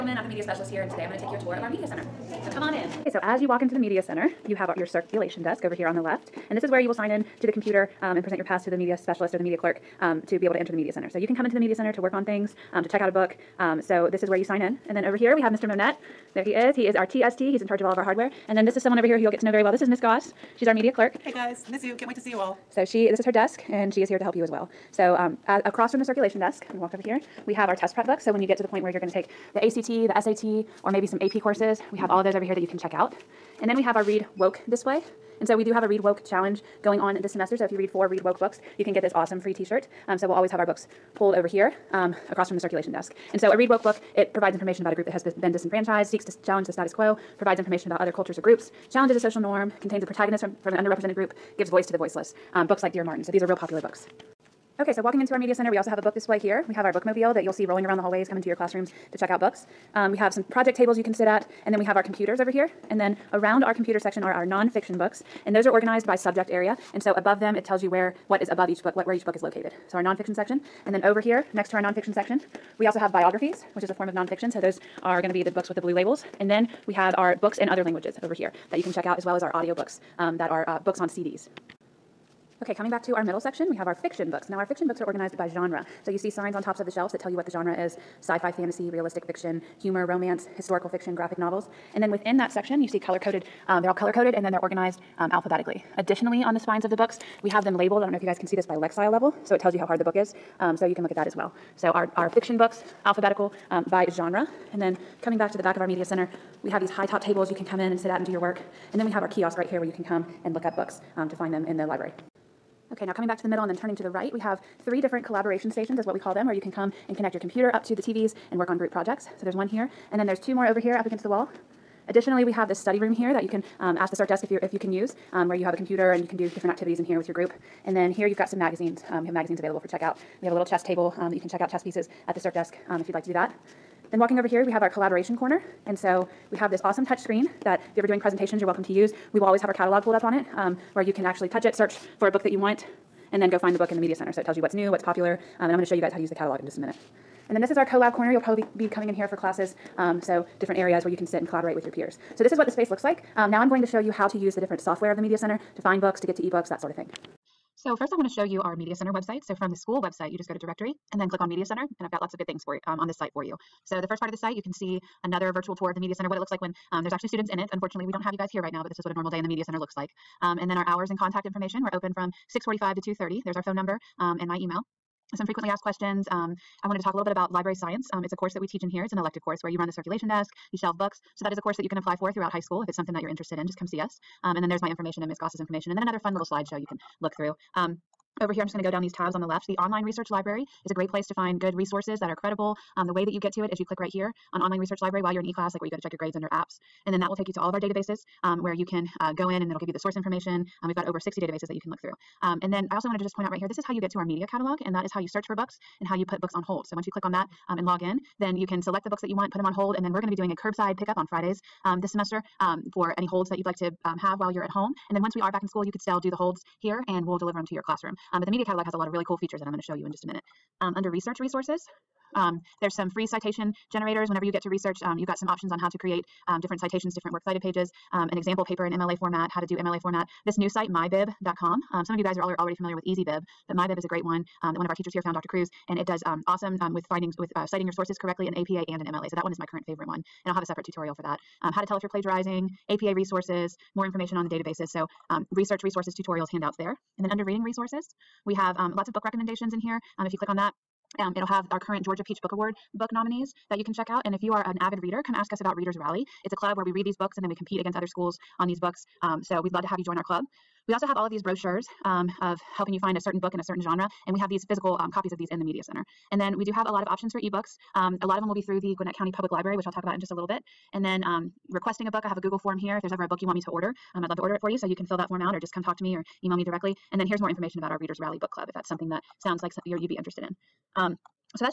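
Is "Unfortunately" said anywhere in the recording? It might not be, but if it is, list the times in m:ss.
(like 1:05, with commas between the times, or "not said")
2:47.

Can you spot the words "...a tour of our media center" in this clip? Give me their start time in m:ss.
0:01.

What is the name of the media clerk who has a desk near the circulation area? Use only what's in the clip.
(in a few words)
Miss Goss.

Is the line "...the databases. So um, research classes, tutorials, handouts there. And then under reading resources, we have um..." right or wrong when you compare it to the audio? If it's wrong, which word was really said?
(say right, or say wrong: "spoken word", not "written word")
wrong: "resources", not "classes".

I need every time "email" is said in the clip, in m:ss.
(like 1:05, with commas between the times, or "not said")
2:54, 4:36.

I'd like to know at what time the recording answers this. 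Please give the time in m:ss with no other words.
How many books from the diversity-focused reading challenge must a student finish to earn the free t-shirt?
0:37.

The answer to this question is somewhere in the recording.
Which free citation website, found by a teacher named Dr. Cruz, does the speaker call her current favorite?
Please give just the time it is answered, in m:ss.
3:50.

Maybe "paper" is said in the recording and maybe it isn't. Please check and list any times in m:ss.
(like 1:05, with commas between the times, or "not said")
3:48.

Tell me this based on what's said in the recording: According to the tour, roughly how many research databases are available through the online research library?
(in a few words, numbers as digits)
over 60.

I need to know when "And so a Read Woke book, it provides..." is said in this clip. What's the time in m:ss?
0:43.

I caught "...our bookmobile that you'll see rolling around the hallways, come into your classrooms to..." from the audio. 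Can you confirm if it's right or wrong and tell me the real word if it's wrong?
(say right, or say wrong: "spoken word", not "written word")
right.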